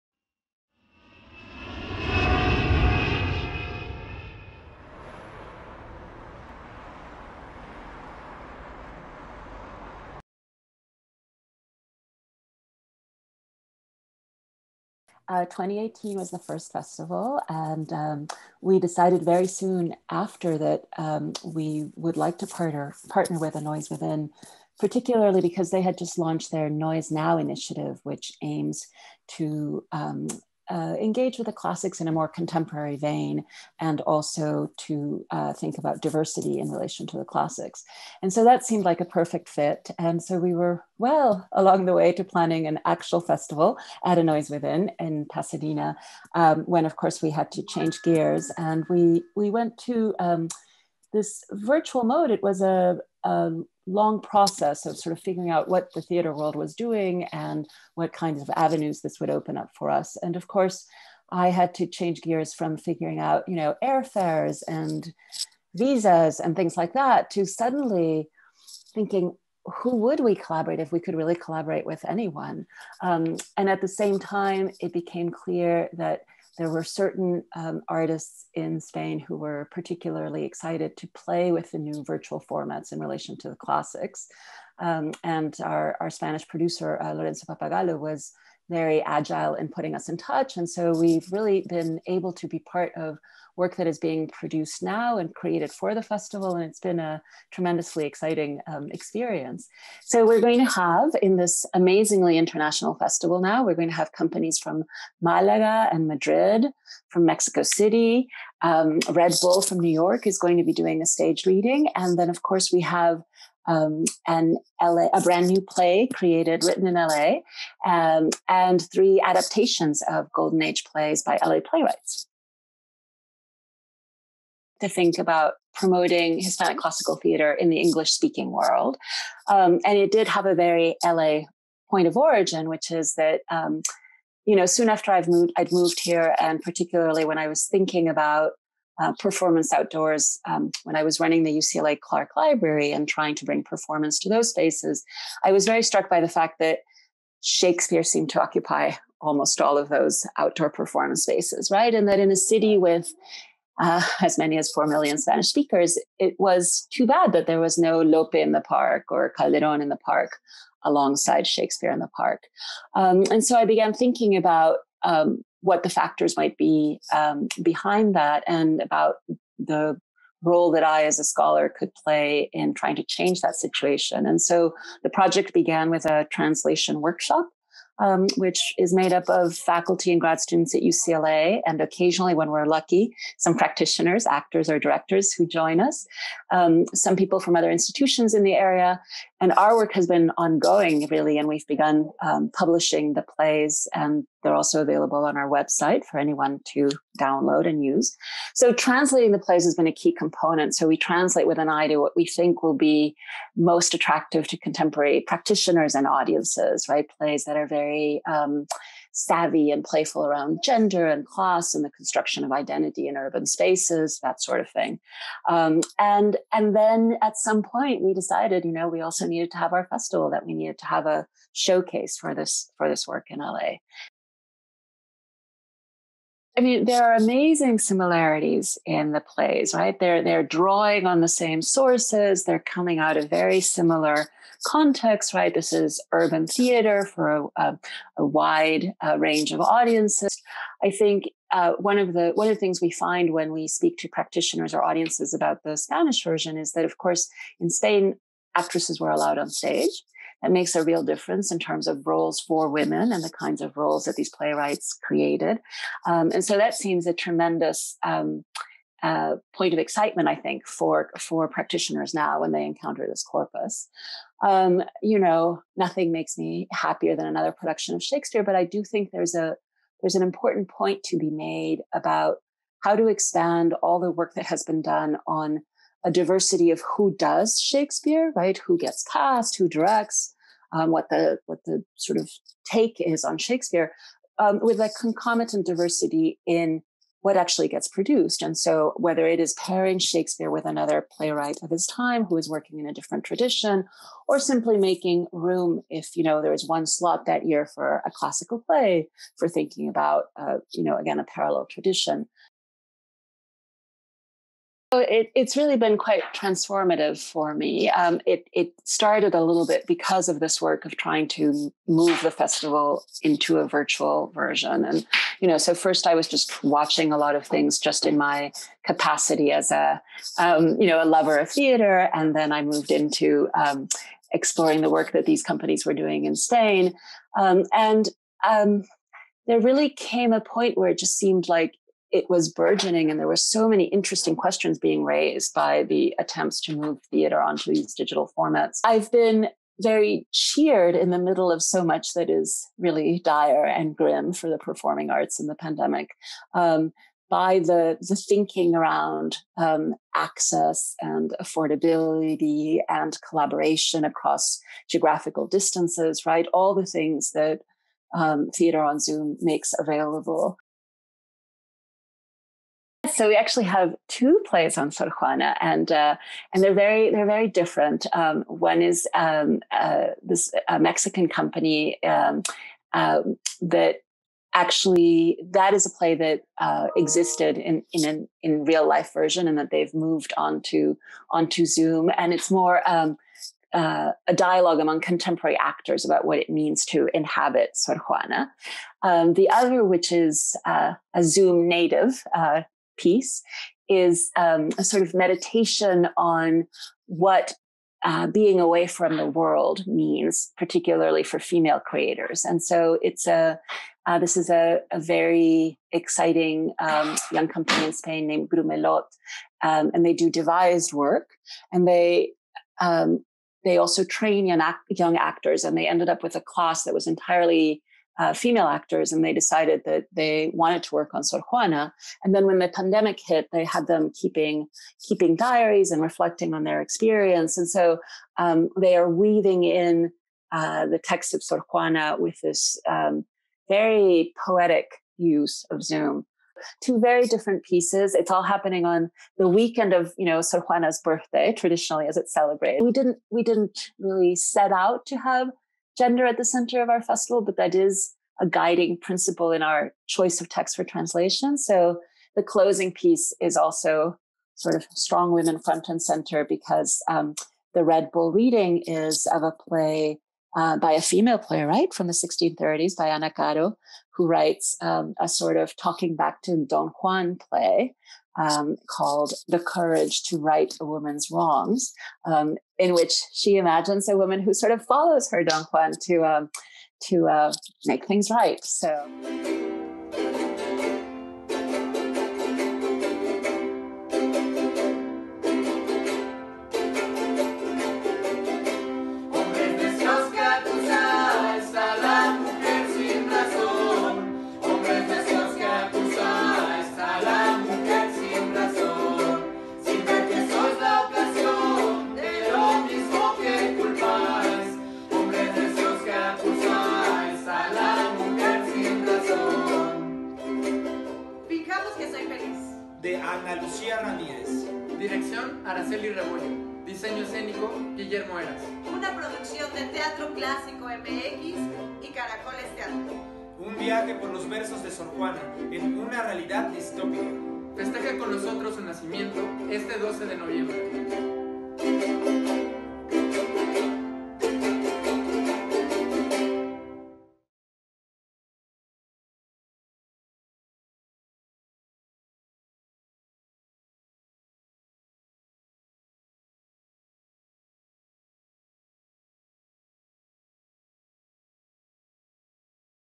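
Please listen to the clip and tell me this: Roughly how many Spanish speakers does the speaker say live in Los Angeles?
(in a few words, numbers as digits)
4 million.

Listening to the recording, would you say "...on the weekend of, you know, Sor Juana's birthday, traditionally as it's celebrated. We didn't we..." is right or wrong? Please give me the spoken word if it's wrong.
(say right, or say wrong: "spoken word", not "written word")
right.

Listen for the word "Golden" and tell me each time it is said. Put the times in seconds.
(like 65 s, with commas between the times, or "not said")
120 s.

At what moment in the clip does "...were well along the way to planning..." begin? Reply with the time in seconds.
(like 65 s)
40 s.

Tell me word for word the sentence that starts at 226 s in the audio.
I mean, there are amazing similarities in the plays, right?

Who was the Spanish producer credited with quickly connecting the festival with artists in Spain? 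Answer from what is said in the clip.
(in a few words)
Lorenzo Papagallo.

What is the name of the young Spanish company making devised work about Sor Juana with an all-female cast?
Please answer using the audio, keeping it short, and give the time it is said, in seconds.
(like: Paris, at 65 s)
Grumelot, at 408 s.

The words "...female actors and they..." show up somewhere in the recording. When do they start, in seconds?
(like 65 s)
418 s.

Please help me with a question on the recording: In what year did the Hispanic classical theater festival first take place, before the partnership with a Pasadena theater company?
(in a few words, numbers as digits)
2018.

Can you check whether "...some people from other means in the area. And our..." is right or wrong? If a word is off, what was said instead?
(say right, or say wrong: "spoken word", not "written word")
wrong: "institutions", not "means".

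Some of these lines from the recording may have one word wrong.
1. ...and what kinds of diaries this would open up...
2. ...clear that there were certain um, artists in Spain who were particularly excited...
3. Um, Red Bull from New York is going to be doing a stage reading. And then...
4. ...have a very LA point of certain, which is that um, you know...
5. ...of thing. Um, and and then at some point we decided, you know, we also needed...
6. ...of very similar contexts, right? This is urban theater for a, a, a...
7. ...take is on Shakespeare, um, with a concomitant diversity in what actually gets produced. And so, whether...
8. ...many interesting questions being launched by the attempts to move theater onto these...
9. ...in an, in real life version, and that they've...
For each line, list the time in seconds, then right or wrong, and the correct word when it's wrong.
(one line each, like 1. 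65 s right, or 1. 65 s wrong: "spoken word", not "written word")
1. 57 s wrong: "avenues", not "diaries"
2. 75 s right
3. 108 s right
4. 130 s wrong: "origin", not "certain"
5. 214 s right
6. 233 s right
7. 282 s right
8. 333 s wrong: "raised", not "launched"
9. 377 s right.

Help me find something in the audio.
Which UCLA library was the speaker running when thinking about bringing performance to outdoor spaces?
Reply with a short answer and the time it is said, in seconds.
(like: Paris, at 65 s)
Clark Library, at 141 s.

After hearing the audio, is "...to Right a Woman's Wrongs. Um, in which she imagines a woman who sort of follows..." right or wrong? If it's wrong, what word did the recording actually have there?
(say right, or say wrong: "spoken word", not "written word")
right.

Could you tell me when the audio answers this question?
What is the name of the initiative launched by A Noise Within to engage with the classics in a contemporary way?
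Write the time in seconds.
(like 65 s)
26 s.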